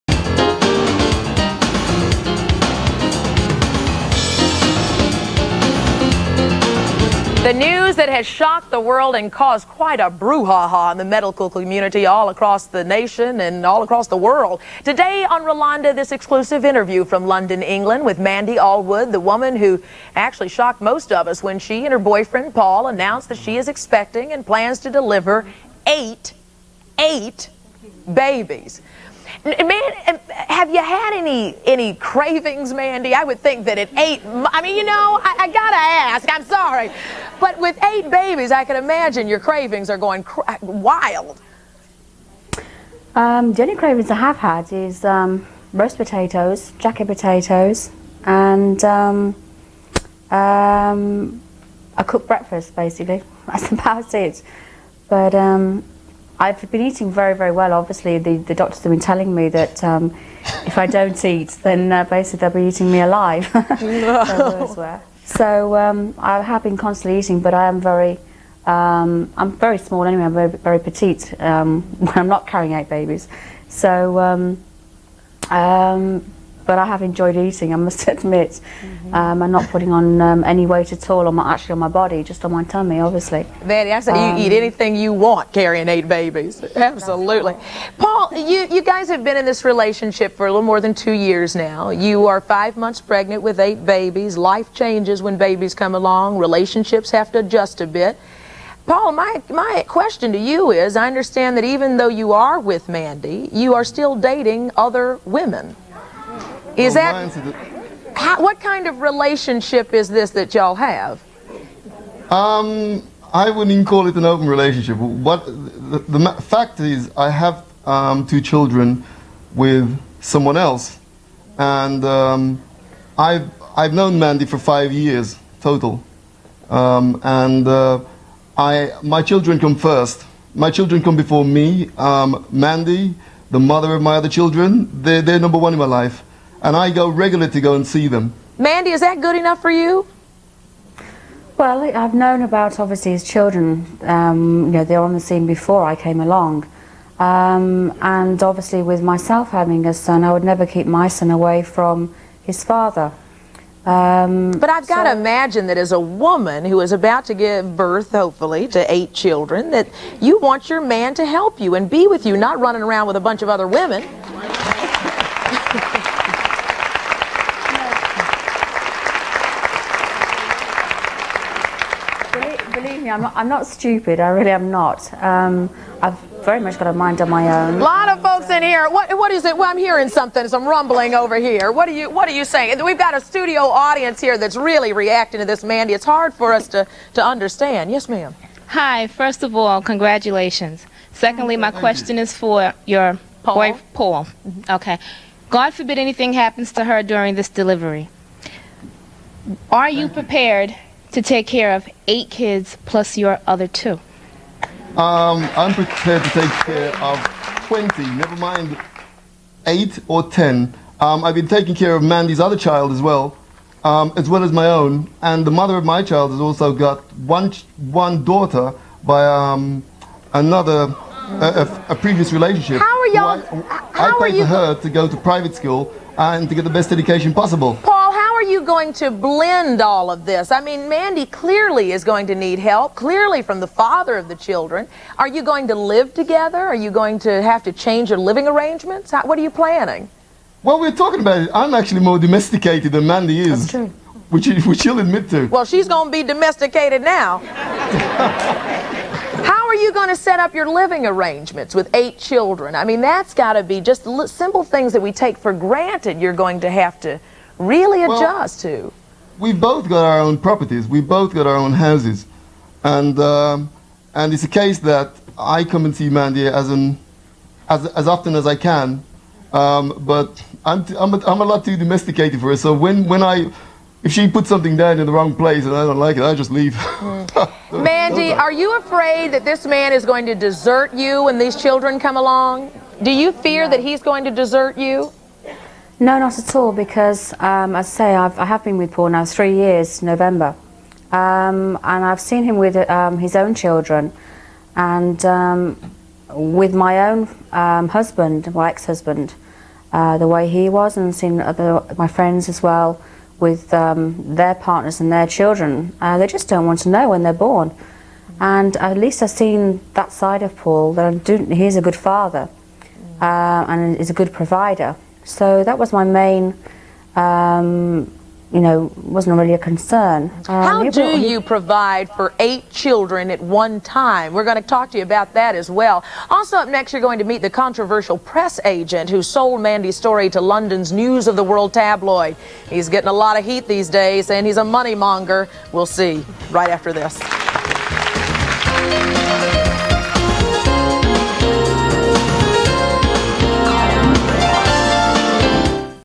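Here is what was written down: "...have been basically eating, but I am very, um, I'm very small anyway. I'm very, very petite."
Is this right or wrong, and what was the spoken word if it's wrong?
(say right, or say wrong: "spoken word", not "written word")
wrong: "constantly", not "basically".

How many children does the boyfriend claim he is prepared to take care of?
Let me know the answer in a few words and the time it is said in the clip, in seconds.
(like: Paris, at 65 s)
20, at 207 s.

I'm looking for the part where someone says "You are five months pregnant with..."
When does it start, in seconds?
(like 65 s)
92 s.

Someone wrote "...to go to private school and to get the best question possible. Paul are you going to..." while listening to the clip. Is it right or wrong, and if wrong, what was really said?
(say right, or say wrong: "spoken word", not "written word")
wrong: "education", not "question".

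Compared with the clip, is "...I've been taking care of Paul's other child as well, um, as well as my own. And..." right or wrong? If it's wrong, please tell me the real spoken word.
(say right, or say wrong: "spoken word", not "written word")
wrong: "Mandy", not "Paul".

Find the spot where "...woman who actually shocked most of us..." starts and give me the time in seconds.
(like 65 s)
19 s.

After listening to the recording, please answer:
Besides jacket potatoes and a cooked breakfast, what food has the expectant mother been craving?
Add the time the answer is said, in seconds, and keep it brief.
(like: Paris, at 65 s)
Roast potatoes, at 45 s.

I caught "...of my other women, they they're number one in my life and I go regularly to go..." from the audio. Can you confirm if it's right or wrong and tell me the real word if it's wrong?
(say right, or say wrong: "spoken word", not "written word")
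wrong: "children", not "women".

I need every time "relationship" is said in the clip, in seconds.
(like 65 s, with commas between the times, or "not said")
89 s, 96 s, 109 s, 114 s, 222 s.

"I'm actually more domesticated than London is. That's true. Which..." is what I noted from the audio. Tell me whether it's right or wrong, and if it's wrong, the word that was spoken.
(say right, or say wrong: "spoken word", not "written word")
wrong: "Mandy", not "London".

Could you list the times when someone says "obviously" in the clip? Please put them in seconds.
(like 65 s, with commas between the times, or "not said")
57 s, 83 s, 142 s, 148 s.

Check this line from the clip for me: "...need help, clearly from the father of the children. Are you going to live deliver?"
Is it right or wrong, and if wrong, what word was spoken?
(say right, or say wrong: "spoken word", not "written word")
wrong: "together", not "deliver".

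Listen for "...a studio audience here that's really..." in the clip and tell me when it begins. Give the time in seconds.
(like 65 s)
183 s.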